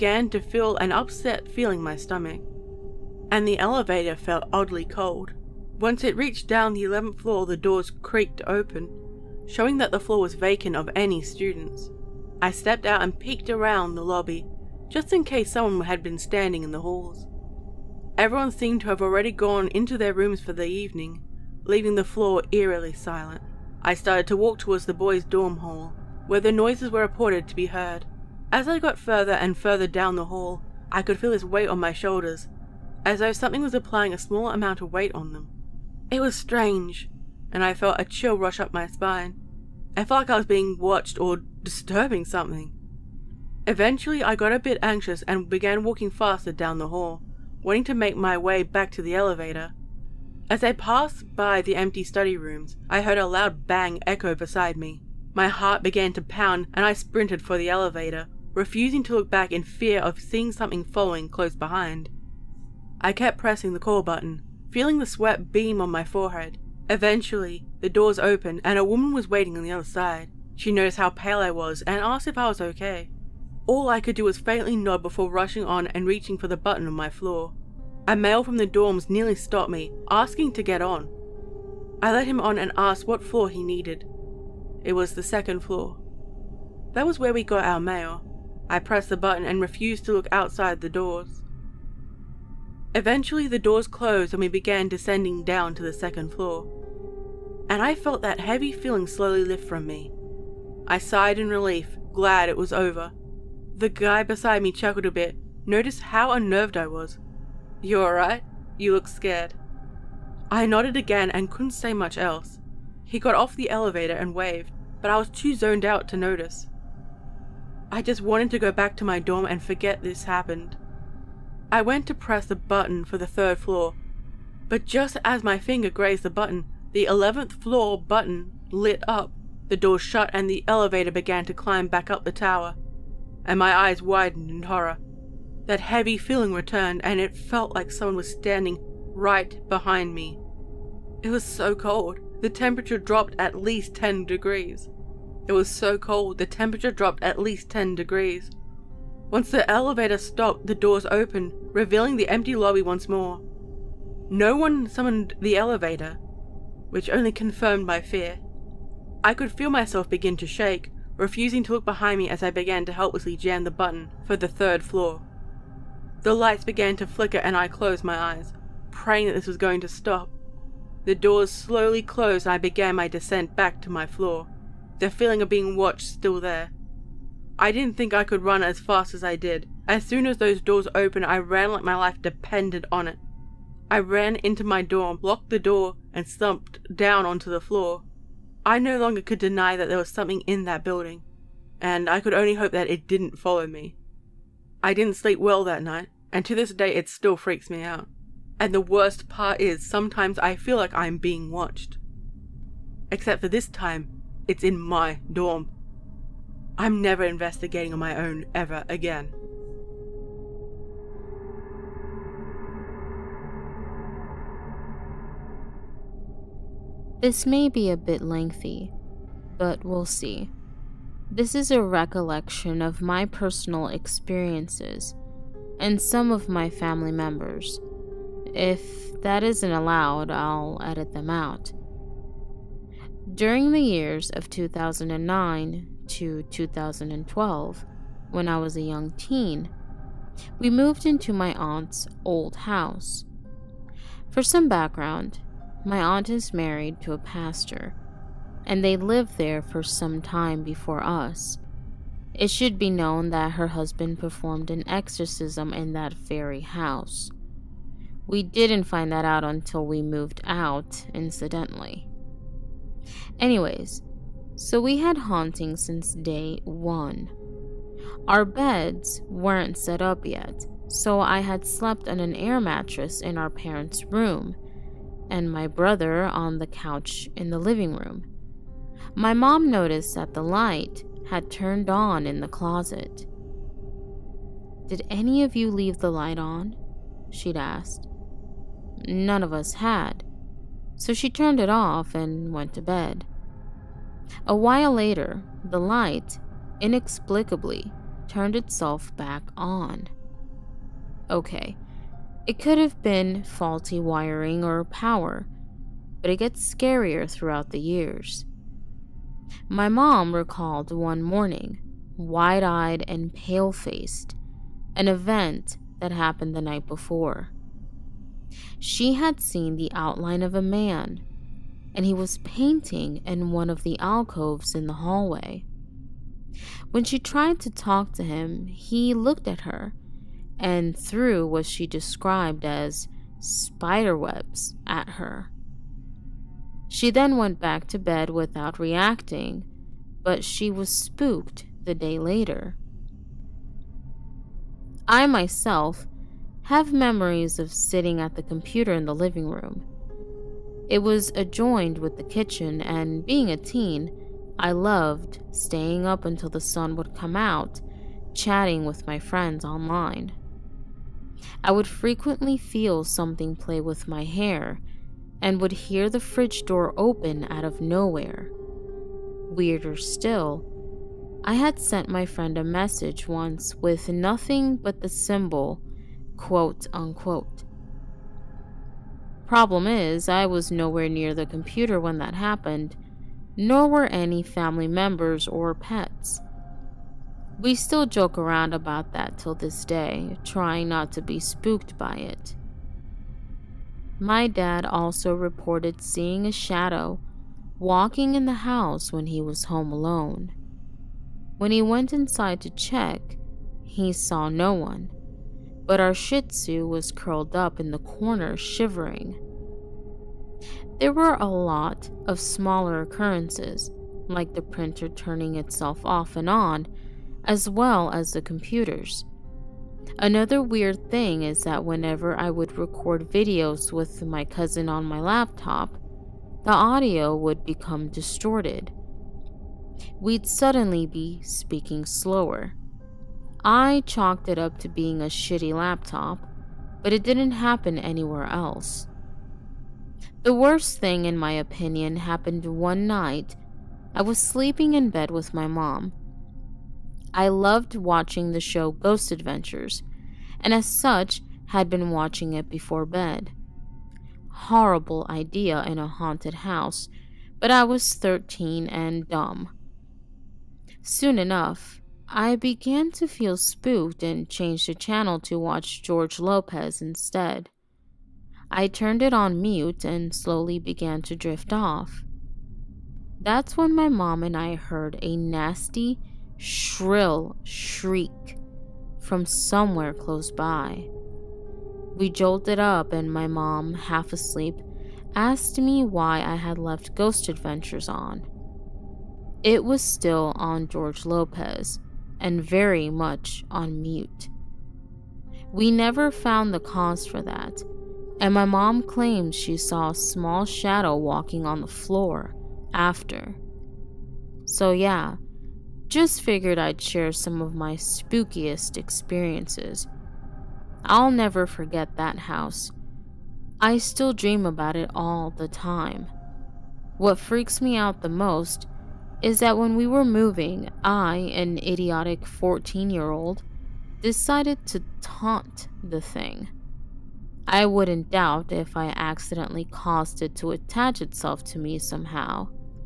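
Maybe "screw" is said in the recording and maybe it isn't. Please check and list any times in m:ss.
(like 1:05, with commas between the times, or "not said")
not said.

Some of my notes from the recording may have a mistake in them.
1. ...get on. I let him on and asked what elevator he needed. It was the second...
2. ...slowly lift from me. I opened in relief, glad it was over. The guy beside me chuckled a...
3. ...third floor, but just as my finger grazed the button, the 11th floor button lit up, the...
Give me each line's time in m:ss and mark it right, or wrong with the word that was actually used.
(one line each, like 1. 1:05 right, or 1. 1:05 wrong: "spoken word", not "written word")
1. 1:20 wrong: "floor", not "elevator"
2. 1:39 wrong: "sighed", not "opened"
3. 2:03 right.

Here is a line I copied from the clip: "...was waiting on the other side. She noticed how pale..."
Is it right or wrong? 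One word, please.
right.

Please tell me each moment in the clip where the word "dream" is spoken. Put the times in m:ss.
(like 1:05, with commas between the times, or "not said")
8:34.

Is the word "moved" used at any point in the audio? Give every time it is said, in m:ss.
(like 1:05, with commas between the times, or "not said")
4:00, 4:20.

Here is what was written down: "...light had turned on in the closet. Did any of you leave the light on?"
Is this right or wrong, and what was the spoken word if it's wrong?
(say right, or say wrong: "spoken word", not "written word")
right.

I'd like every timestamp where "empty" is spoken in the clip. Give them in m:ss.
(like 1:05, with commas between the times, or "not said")
0:51, 2:32.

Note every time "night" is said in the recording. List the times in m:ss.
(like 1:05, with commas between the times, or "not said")
3:15, 5:16, 7:23.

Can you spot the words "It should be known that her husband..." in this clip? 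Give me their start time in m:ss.
4:12.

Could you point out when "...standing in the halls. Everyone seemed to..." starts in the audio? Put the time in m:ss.
0:16.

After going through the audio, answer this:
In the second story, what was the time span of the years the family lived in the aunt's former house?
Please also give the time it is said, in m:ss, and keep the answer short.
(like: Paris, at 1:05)
2009 to 2012, at 3:54.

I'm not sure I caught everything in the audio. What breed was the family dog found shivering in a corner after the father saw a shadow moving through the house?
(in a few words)
Shih Tzu.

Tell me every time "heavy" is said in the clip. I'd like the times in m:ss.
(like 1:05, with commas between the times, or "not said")
1:38, 2:15.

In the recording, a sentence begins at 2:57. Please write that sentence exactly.
I didn't think I could run as fast as I did.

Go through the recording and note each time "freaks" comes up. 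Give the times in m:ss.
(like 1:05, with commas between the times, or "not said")
3:17, 8:37.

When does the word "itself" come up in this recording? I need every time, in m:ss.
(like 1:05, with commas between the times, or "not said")
4:58, 6:55, 8:51.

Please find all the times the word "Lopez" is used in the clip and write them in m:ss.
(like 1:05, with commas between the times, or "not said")
7:46, 8:11.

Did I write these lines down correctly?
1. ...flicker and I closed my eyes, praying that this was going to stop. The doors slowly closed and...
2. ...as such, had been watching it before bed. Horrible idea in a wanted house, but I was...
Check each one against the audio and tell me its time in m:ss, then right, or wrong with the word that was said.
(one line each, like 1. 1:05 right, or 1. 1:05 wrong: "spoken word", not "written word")
1. 2:47 right
2. 7:30 wrong: "haunted", not "wanted".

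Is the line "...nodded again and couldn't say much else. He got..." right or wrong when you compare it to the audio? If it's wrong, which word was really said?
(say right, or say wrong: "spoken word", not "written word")
right.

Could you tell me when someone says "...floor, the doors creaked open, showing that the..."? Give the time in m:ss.
0:07.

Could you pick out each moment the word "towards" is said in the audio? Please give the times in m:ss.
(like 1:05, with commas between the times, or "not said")
0:24.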